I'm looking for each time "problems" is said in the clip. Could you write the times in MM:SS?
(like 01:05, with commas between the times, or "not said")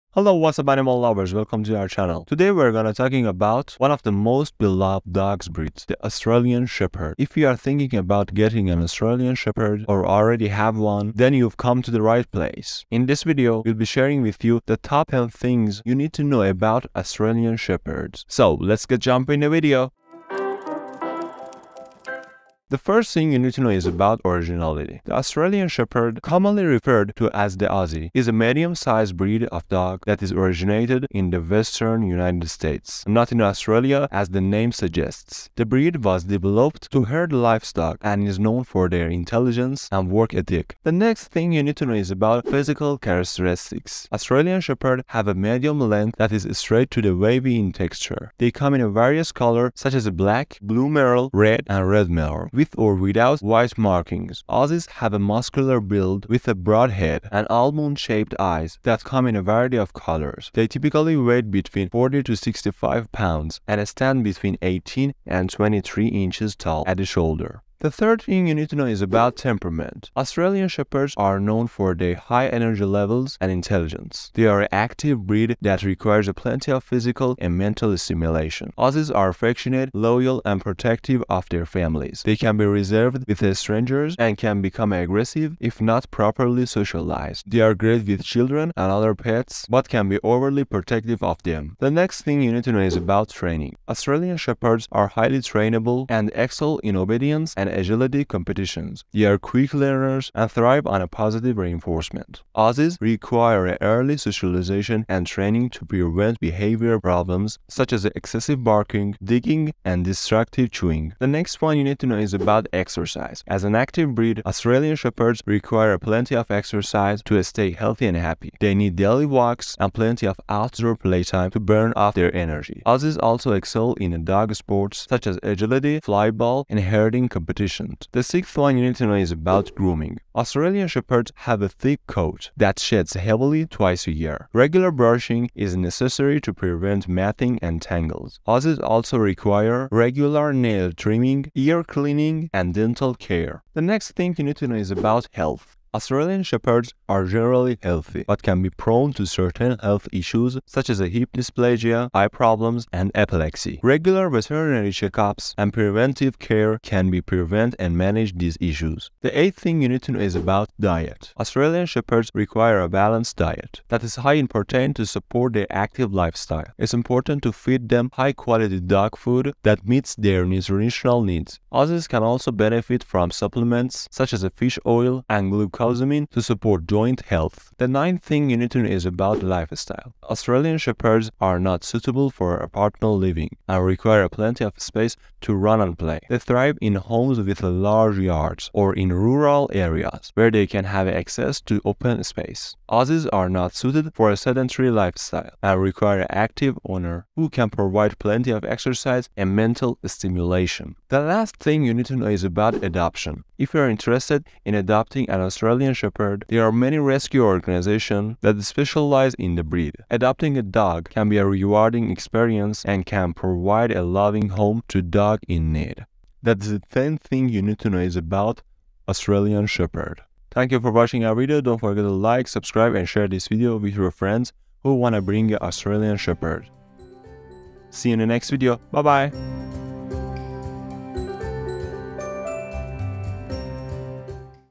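01:47, 02:32.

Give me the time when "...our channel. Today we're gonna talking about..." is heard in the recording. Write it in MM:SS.
00:01.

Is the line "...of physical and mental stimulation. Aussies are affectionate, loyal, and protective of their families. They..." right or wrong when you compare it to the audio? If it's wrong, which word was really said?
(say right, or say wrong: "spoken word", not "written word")
right.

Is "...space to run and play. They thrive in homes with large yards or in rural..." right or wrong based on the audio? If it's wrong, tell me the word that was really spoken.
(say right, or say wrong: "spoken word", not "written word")
right.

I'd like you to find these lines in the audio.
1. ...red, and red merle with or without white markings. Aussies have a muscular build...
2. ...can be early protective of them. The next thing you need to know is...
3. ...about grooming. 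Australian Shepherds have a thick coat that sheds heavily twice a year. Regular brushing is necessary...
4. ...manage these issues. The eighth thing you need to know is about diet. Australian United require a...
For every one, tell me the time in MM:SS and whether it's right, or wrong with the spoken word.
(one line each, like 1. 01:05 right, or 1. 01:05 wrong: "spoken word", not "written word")
1. 00:51 right
2. 01:29 wrong: "overly", not "early"
3. 02:09 right
4. 02:37 wrong: "Shepherds", not "United".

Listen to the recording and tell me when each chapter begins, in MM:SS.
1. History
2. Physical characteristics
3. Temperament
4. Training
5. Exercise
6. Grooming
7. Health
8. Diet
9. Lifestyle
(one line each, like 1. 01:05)
1. 00:22
2. 00:40
3. 01:08
4. 01:31
5. 01:51
6. 02:08
7. 02:24
8. 02:39
9. 02:57.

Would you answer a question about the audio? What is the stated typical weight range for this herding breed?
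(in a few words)
40 to 65 pounds.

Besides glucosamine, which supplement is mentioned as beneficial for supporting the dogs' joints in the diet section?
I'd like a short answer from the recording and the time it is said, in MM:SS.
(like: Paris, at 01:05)
fish oil, at 02:54.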